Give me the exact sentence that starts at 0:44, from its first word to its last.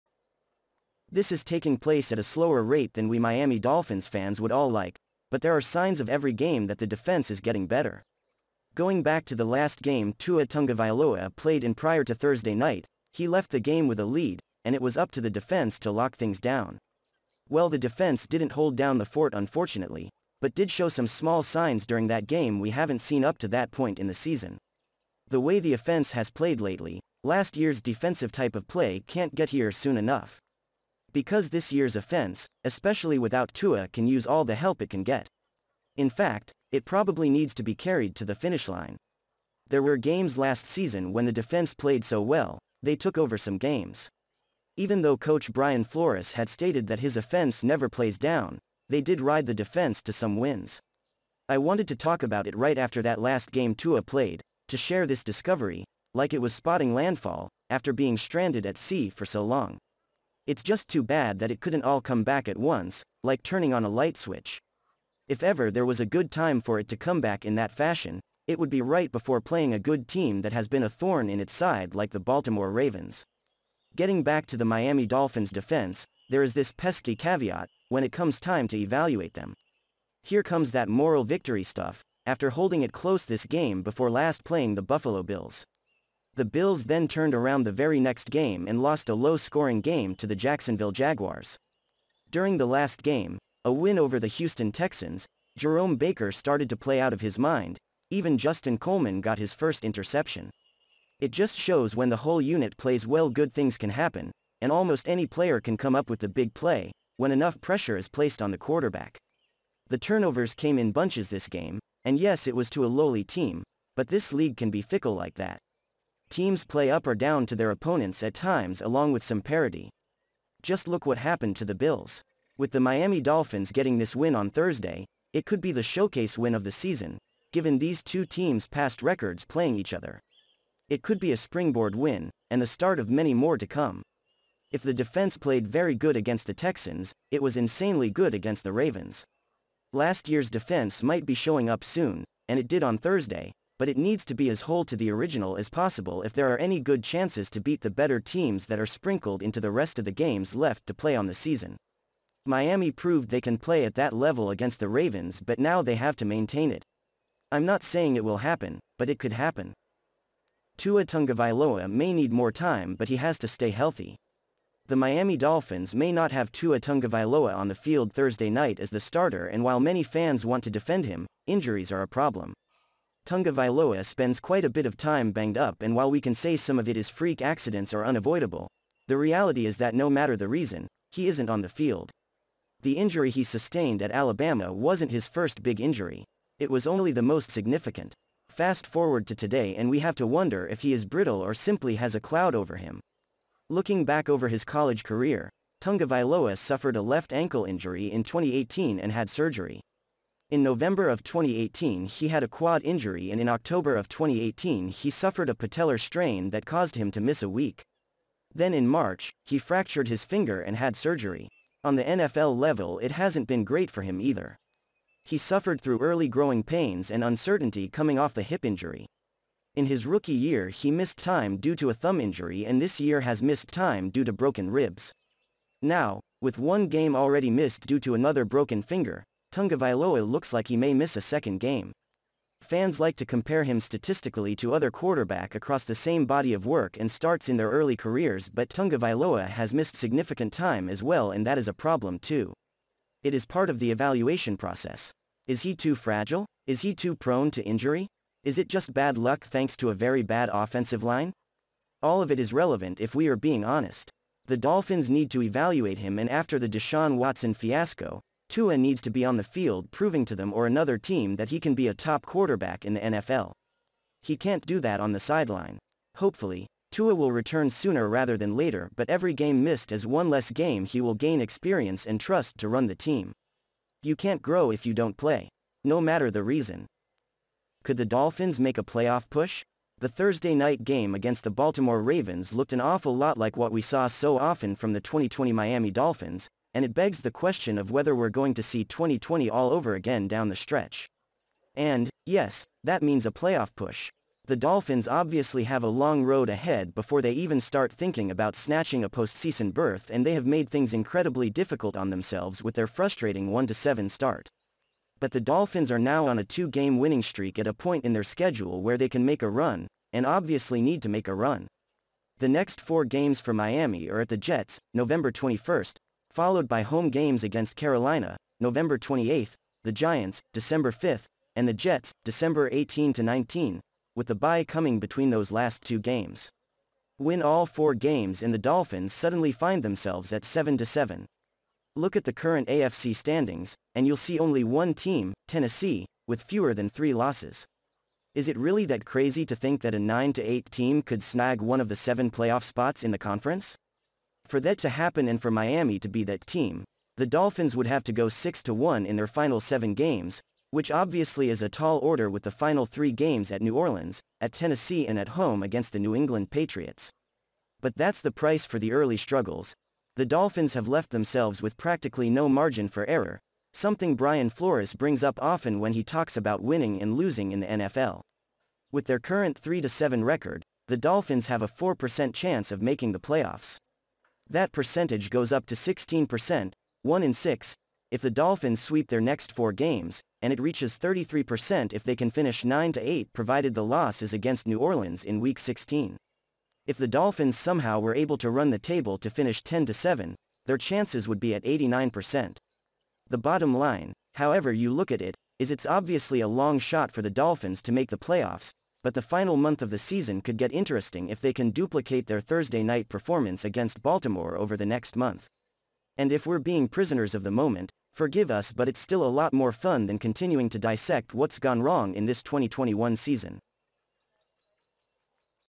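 Even though coach Brian Flores had stated that his offense never plays down, they did ride the defense to some wins.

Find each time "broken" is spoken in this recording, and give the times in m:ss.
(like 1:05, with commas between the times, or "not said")
3:44, 3:48.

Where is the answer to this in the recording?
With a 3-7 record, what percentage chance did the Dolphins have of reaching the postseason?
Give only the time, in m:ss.
6:11.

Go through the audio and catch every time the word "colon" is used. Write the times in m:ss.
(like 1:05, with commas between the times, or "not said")
not said.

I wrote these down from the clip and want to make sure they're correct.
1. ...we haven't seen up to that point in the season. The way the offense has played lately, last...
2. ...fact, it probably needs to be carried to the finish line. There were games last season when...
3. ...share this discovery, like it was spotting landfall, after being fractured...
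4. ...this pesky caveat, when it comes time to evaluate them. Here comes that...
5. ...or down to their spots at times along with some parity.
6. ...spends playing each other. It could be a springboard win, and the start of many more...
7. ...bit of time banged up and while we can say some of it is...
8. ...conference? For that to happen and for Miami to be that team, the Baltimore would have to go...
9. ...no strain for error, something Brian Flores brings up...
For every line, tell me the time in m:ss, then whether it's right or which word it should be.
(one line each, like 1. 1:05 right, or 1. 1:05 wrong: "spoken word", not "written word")
1. 0:22 right
2. 0:36 right
3. 0:54 wrong: "stranded", not "fractured"
4. 1:16 right
5. 1:57 wrong: "opponents", not "spots"
6. 2:09 wrong: "records", not "spends"
7. 2:54 right
8. 5:43 wrong: "Dolphins", not "Baltimore"
9. 6:02 wrong: "margin", not "strain".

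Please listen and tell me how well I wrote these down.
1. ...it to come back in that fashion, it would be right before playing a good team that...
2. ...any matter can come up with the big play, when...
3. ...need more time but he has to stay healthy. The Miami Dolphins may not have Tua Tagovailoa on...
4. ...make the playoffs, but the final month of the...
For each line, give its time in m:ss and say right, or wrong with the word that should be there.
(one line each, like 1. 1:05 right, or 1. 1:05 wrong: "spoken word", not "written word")
1. 1:06 right
2. 1:45 wrong: "player", not "matter"
3. 2:42 right
4. 6:37 right.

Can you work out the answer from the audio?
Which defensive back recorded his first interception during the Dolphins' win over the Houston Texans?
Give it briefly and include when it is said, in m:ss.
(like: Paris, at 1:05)
Justin Coleman, at 1:38.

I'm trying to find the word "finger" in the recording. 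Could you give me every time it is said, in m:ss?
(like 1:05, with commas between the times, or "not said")
3:30, 3:48.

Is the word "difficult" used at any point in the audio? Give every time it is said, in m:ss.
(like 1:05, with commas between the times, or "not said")
5:01.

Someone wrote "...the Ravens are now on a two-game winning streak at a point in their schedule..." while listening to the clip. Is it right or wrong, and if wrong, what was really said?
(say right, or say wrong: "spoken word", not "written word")
wrong: "Dolphins", not "Ravens".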